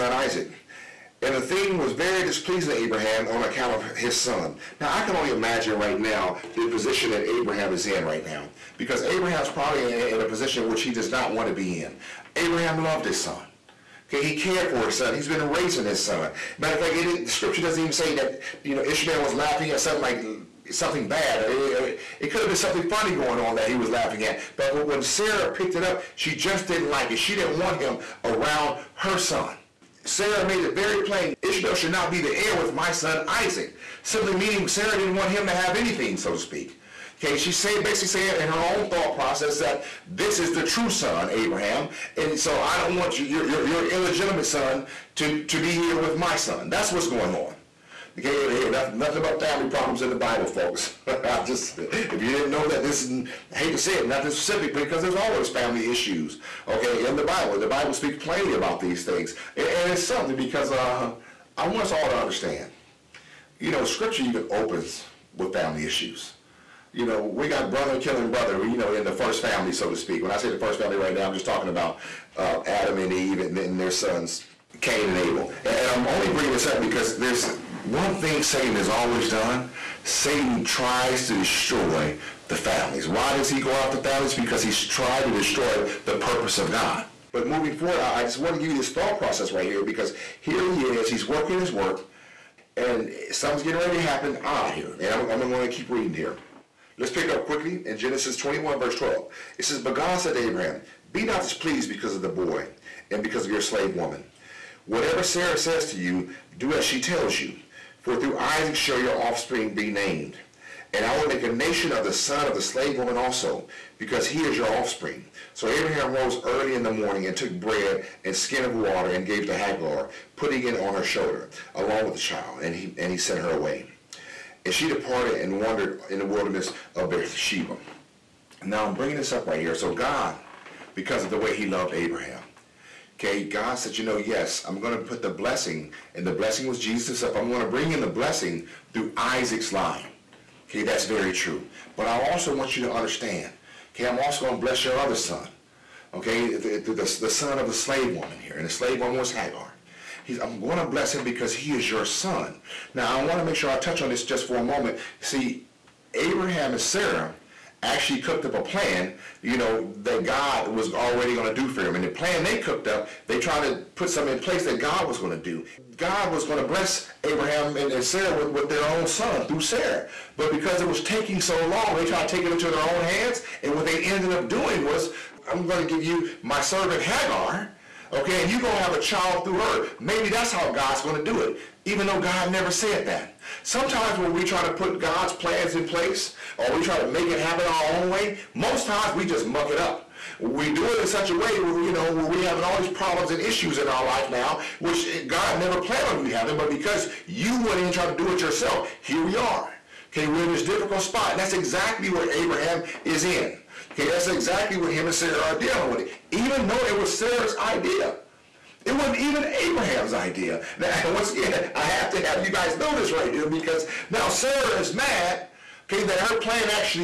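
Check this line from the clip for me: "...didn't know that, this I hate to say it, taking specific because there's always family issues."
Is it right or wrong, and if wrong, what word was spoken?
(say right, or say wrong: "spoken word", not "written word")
wrong: "nothing", not "taking".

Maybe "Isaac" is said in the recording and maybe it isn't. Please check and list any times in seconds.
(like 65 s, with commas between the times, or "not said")
0 s, 33 s, 108 s, 139 s.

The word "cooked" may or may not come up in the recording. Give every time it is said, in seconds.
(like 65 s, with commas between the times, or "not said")
158 s, 162 s.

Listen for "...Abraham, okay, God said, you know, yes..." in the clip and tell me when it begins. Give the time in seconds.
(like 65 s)
131 s.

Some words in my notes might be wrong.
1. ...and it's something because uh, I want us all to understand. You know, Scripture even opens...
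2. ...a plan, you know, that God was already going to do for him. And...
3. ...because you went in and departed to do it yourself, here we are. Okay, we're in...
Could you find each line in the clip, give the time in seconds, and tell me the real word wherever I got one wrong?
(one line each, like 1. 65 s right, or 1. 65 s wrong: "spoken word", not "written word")
1. 59 s right
2. 158 s right
3. 196 s wrong: "tried", not "departed".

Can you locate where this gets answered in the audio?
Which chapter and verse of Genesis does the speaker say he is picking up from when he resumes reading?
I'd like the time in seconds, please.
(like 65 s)
97 s.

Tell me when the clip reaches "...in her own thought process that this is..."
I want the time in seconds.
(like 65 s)
38 s.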